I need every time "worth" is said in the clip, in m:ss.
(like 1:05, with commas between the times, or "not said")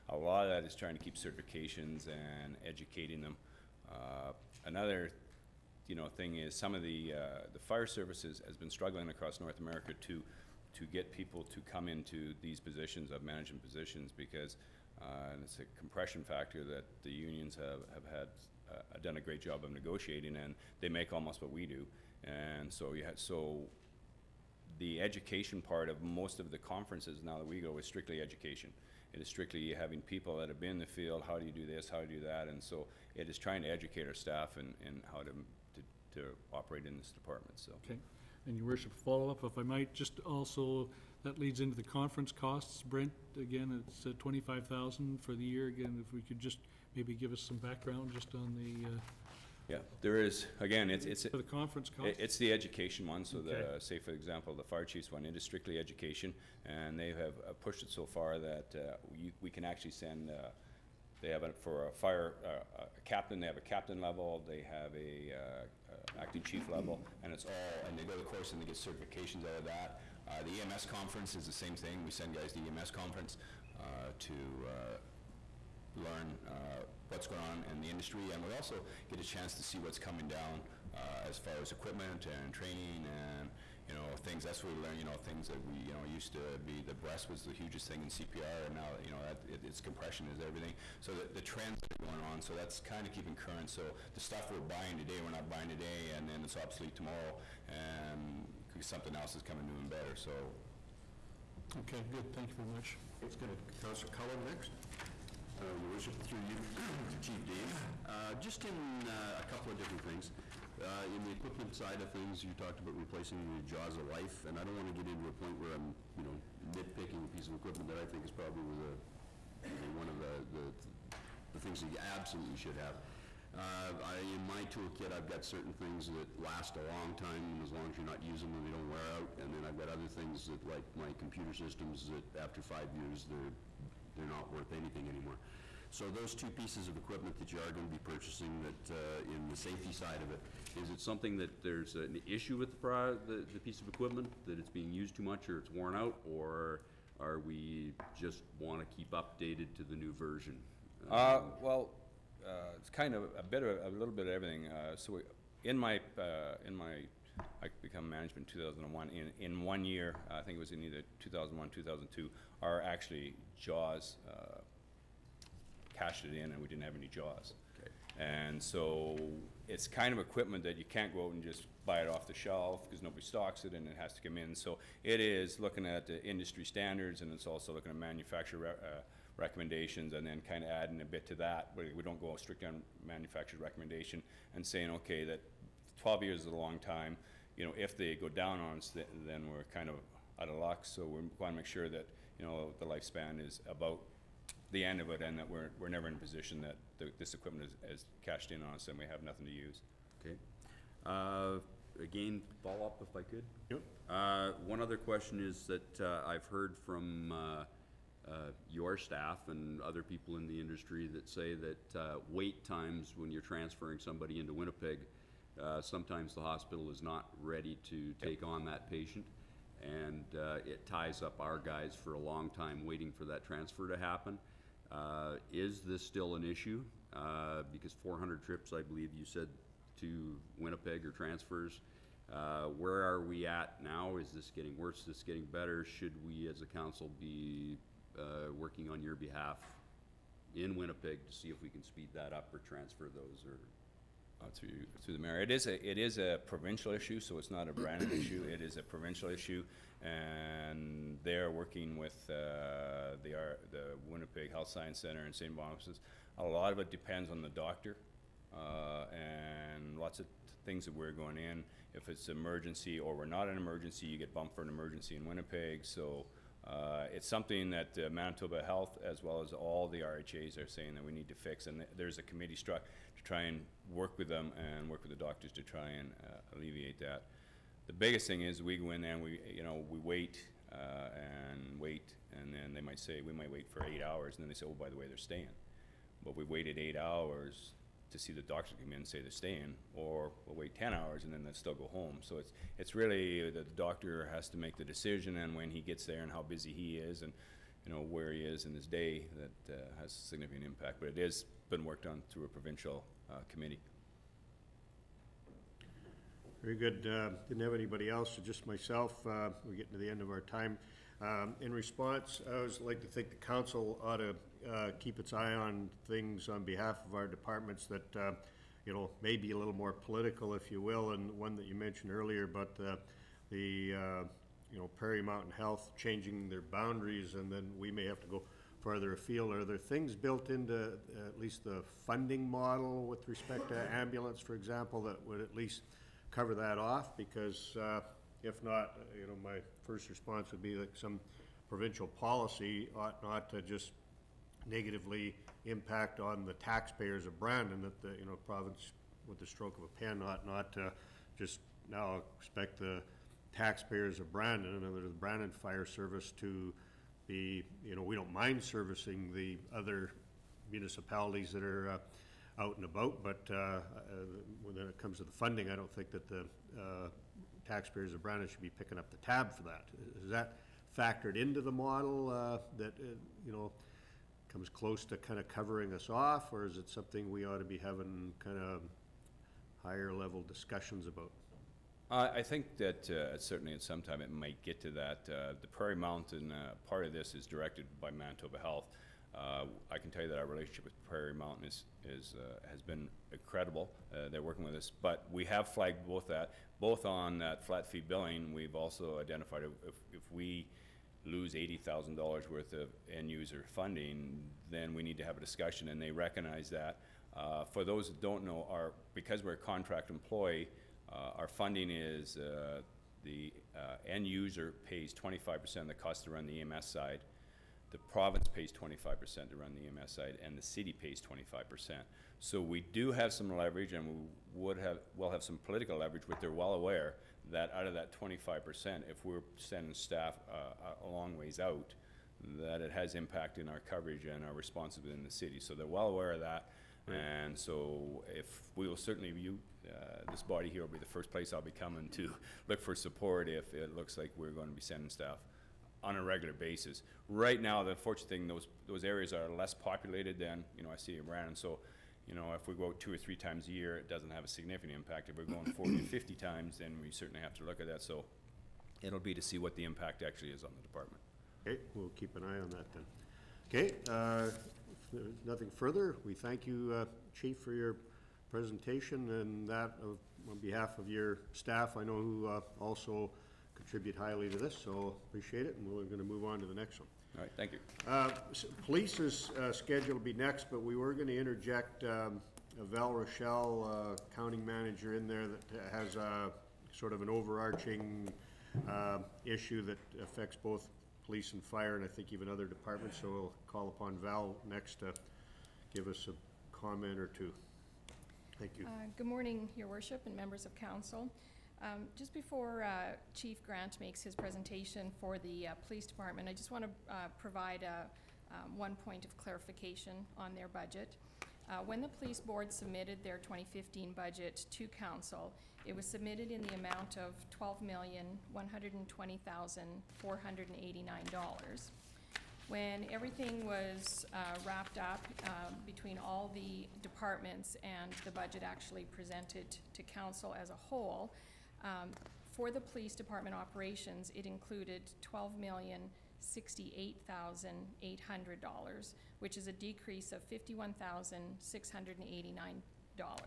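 2:14, 6:42.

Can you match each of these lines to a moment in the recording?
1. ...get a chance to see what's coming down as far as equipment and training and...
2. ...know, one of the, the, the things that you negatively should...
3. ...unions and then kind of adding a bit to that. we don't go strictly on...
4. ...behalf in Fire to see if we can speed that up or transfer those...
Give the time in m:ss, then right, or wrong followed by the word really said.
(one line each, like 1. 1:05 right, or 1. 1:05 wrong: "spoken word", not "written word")
1. 1:19 right
2. 1:59 wrong: "absolutely", not "negatively"
3. 2:59 wrong: "recommendations", not "unions"
4. 3:59 wrong: "Winnipeg", not "Fire".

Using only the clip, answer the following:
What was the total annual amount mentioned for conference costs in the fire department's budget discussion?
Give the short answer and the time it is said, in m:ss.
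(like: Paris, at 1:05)
$25,000, at 0:44.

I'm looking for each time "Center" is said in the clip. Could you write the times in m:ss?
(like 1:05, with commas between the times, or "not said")
4:14.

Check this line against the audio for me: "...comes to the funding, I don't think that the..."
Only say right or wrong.
right.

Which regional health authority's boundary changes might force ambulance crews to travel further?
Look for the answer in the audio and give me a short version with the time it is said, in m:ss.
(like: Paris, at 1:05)
Prairie Mountain Health, at 5:24.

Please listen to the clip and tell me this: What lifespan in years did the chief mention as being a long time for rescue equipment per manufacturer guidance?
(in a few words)
12 years.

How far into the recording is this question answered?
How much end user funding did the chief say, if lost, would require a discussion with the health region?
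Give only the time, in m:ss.
6:41.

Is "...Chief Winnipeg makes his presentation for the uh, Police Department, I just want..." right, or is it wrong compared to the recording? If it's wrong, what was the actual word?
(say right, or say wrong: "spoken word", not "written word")
wrong: "Grant", not "Winnipeg".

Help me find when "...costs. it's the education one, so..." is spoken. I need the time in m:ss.
0:51.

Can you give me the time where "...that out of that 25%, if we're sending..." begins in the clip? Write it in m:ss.
7:07.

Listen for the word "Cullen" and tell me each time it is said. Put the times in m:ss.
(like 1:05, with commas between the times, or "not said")
1:44.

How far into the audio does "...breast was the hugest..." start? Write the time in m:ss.
1:26.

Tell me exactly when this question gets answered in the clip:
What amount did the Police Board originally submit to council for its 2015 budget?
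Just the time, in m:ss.
8:37.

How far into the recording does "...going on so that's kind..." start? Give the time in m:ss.
1:31.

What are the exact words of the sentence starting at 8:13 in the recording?
So we'll call upon Val next to give us a comment or two.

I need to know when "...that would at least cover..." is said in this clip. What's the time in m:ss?
5:35.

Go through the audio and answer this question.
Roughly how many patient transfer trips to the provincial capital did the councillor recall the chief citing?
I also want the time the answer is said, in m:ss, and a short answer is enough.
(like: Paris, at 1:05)
400, at 3:48.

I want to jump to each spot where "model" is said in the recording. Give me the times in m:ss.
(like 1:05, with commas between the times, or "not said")
5:32, 6:11.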